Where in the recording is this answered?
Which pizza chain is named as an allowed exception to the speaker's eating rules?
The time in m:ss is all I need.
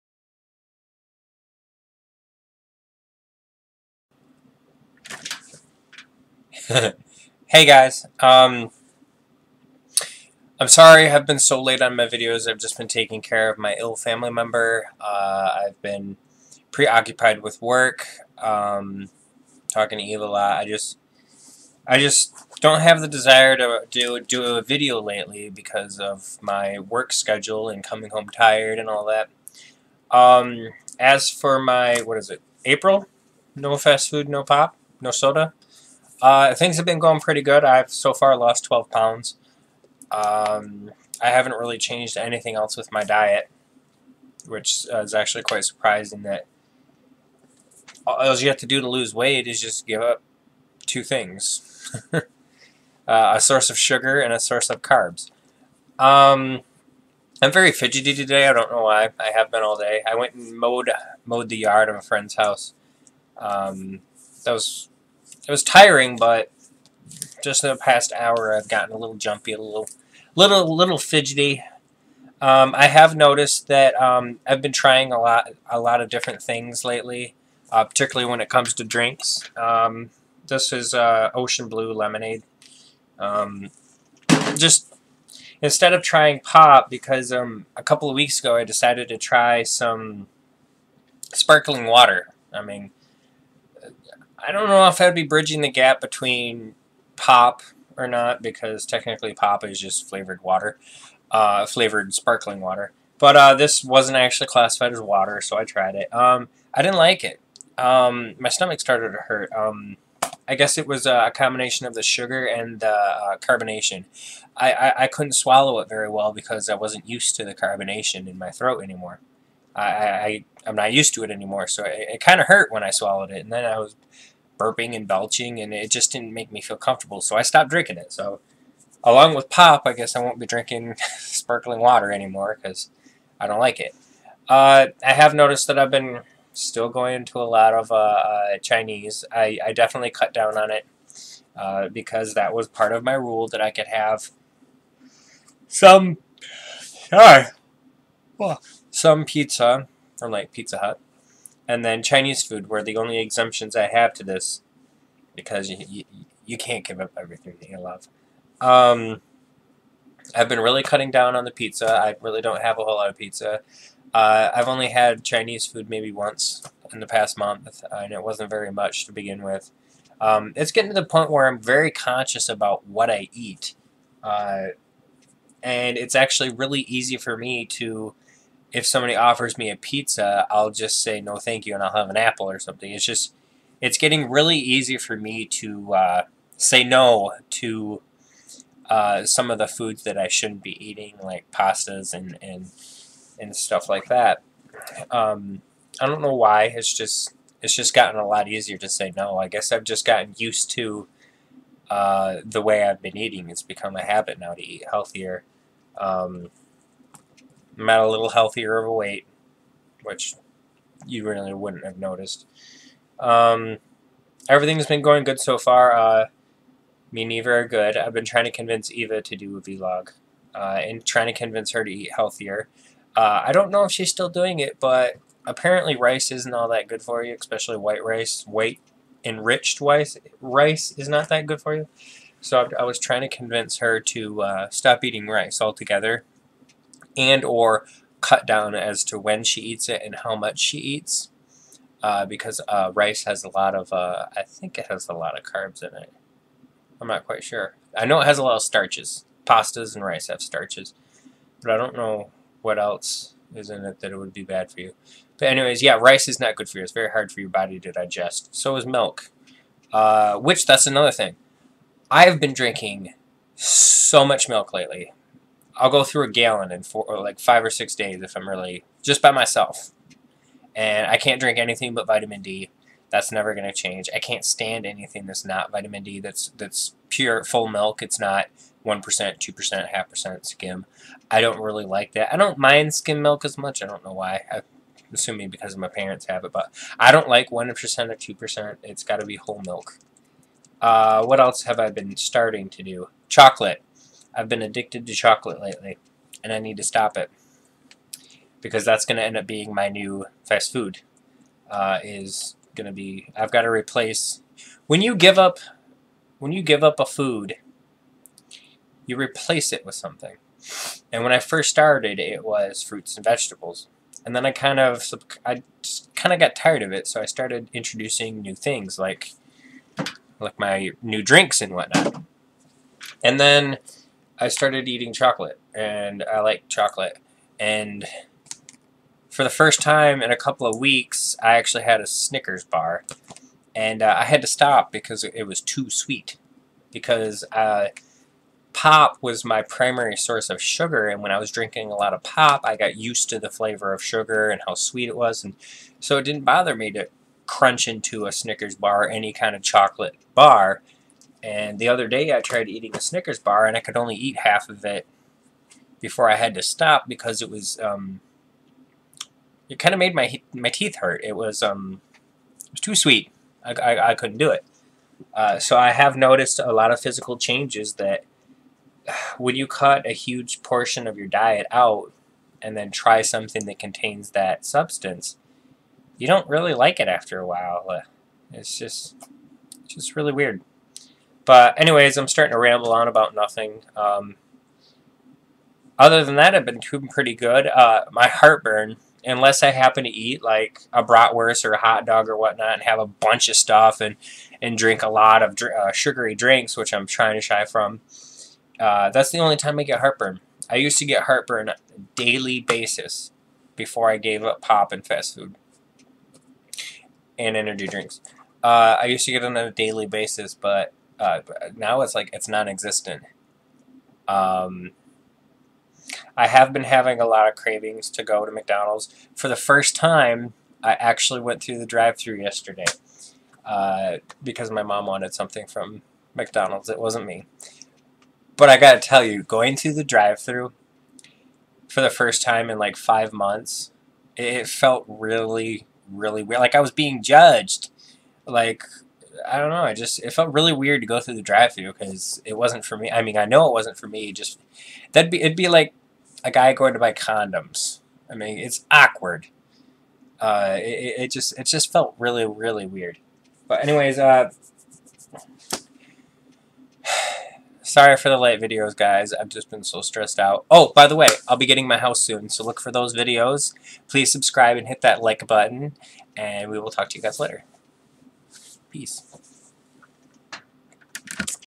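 2:30.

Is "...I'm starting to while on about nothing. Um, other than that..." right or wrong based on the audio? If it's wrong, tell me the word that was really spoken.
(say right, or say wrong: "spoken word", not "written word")
wrong: "ramble", not "while".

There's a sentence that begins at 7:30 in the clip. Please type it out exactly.
Uh, it, it just it just felt really really weird.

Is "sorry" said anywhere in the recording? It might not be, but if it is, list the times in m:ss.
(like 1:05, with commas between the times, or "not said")
0:10, 2:27, 7:37.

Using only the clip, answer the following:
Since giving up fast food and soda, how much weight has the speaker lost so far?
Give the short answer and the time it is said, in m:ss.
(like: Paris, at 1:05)
12 pounds, at 0:38.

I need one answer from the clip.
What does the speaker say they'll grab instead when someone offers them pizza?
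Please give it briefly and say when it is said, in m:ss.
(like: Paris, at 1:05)
an apple, at 3:02.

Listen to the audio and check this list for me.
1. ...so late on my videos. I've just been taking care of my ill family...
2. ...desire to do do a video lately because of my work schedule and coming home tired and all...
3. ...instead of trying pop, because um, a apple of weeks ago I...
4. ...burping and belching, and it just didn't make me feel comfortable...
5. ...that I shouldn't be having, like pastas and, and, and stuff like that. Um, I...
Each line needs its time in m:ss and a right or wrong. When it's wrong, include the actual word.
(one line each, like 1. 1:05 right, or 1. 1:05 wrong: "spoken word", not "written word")
1. 0:11 right
2. 0:23 right
3. 1:25 wrong: "couple", not "apple"
4. 2:04 right
5. 3:10 wrong: "eating", not "having".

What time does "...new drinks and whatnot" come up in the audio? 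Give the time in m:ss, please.
5:21.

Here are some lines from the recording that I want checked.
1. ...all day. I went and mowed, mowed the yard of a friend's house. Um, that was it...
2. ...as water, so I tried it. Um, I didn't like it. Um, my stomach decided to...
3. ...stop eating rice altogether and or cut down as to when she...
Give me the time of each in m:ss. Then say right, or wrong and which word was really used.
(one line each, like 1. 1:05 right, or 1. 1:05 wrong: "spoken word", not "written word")
1. 0:59 right
2. 1:44 wrong: "started", not "decided"
3. 3:54 right.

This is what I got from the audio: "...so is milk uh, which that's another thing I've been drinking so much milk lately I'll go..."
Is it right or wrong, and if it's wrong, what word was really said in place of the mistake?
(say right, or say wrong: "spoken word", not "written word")
right.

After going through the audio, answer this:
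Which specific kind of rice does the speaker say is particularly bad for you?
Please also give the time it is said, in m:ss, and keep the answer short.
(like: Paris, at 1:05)
White enriched rice, at 3:48.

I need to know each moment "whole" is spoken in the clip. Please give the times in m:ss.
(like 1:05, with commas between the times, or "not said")
2:42, 4:49.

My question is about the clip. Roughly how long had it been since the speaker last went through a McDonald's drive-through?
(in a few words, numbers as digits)
5 months.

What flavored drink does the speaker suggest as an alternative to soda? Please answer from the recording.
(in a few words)
Ocean Blue Lemonade.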